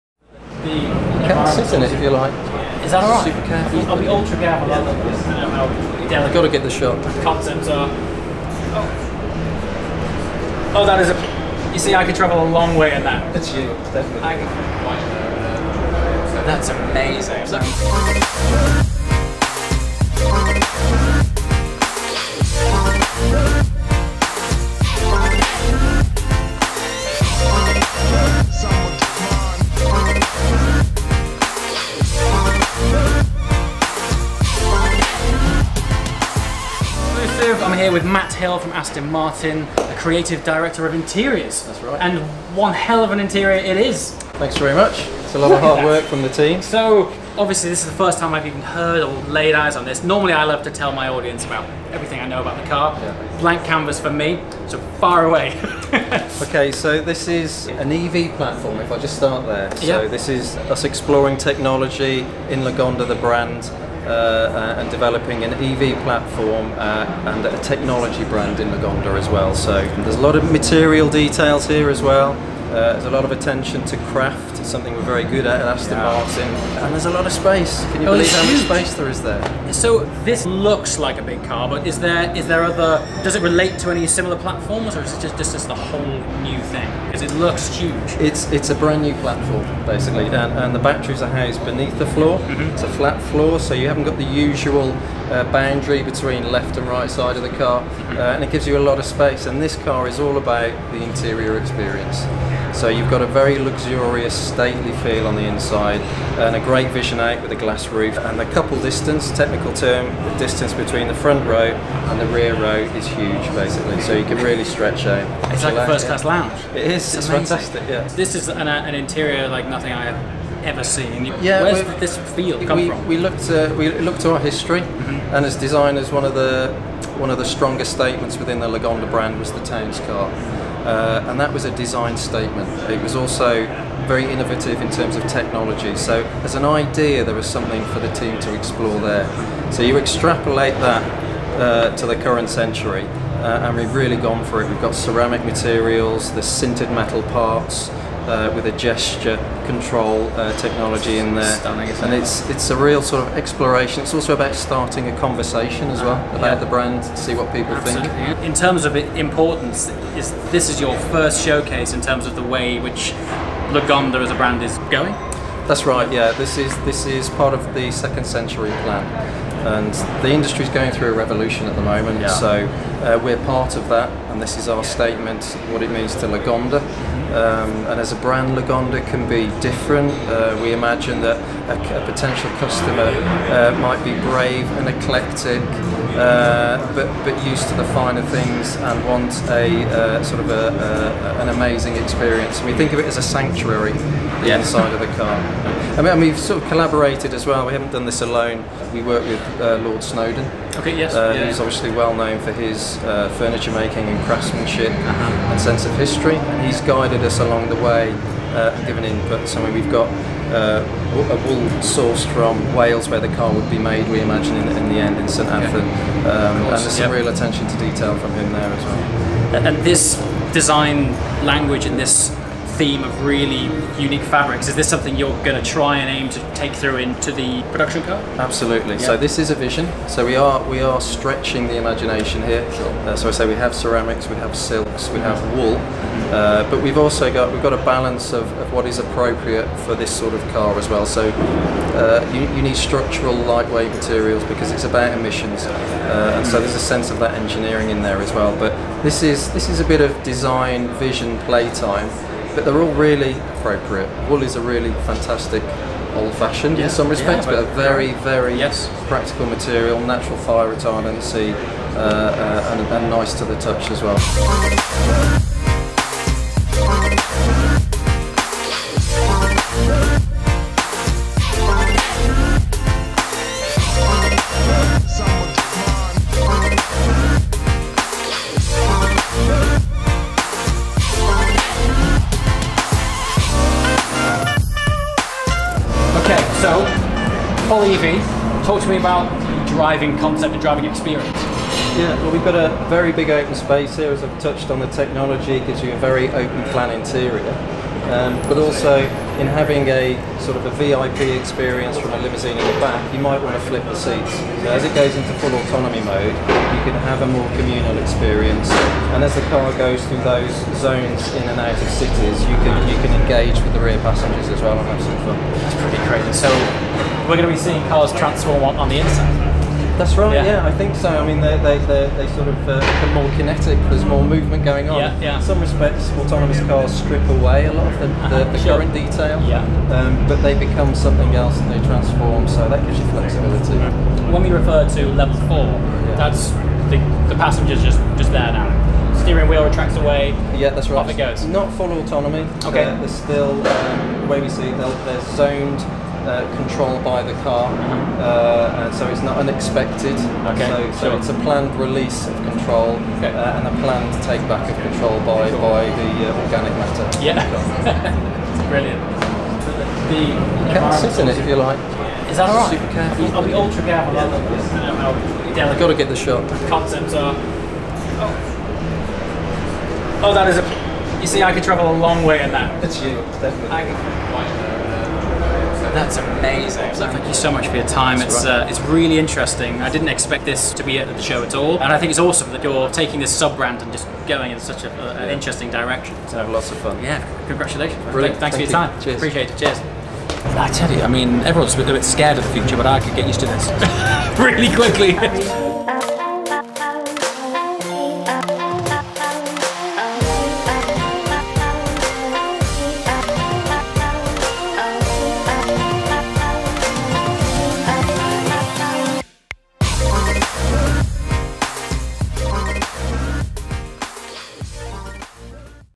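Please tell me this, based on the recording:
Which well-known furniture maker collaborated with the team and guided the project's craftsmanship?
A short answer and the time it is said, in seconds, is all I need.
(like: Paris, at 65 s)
Lord Snowdon, at 199 s.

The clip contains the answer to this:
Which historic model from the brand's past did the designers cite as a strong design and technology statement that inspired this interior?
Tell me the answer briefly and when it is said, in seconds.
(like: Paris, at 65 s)
Towns car, at 129 s.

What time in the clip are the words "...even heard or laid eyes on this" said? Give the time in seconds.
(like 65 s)
48 s.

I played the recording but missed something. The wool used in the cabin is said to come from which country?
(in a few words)
Wales.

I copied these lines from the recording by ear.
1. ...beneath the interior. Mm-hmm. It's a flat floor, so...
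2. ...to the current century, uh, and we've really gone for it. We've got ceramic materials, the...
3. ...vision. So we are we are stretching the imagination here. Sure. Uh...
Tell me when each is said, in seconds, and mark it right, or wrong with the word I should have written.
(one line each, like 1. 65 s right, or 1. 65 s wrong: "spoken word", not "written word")
1. 91 s wrong: "floor", not "interior"
2. 141 s right
3. 229 s right.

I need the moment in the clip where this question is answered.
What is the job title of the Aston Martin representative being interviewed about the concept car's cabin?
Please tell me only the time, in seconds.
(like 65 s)
39 s.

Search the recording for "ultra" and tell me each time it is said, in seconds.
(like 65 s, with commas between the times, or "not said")
4 s, 363 s.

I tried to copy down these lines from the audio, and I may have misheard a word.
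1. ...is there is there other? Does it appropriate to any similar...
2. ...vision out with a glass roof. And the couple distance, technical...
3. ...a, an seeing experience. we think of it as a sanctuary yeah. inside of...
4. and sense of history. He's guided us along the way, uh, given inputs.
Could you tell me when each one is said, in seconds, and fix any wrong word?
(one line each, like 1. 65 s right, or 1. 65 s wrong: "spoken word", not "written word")
1. 81 s wrong: "relate", not "appropriate"
2. 106 s right
3. 190 s wrong: "amazing", not "seeing"
4. 205 s right.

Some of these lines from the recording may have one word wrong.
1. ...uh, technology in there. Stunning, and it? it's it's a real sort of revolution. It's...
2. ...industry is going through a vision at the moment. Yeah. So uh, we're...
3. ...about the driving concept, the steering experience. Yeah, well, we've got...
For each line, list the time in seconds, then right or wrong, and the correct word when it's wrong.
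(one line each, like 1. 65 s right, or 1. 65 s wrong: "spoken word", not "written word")
1. 150 s wrong: "exploration", not "revolution"
2. 170 s wrong: "revolution", not "vision"
3. 288 s wrong: "driving", not "steering".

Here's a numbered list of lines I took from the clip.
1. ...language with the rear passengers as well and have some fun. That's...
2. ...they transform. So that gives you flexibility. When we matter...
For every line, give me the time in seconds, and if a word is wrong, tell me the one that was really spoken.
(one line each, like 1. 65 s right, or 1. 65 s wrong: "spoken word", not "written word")
1. 313 s wrong: "engage", not "language"
2. 331 s wrong: "refer", not "matter".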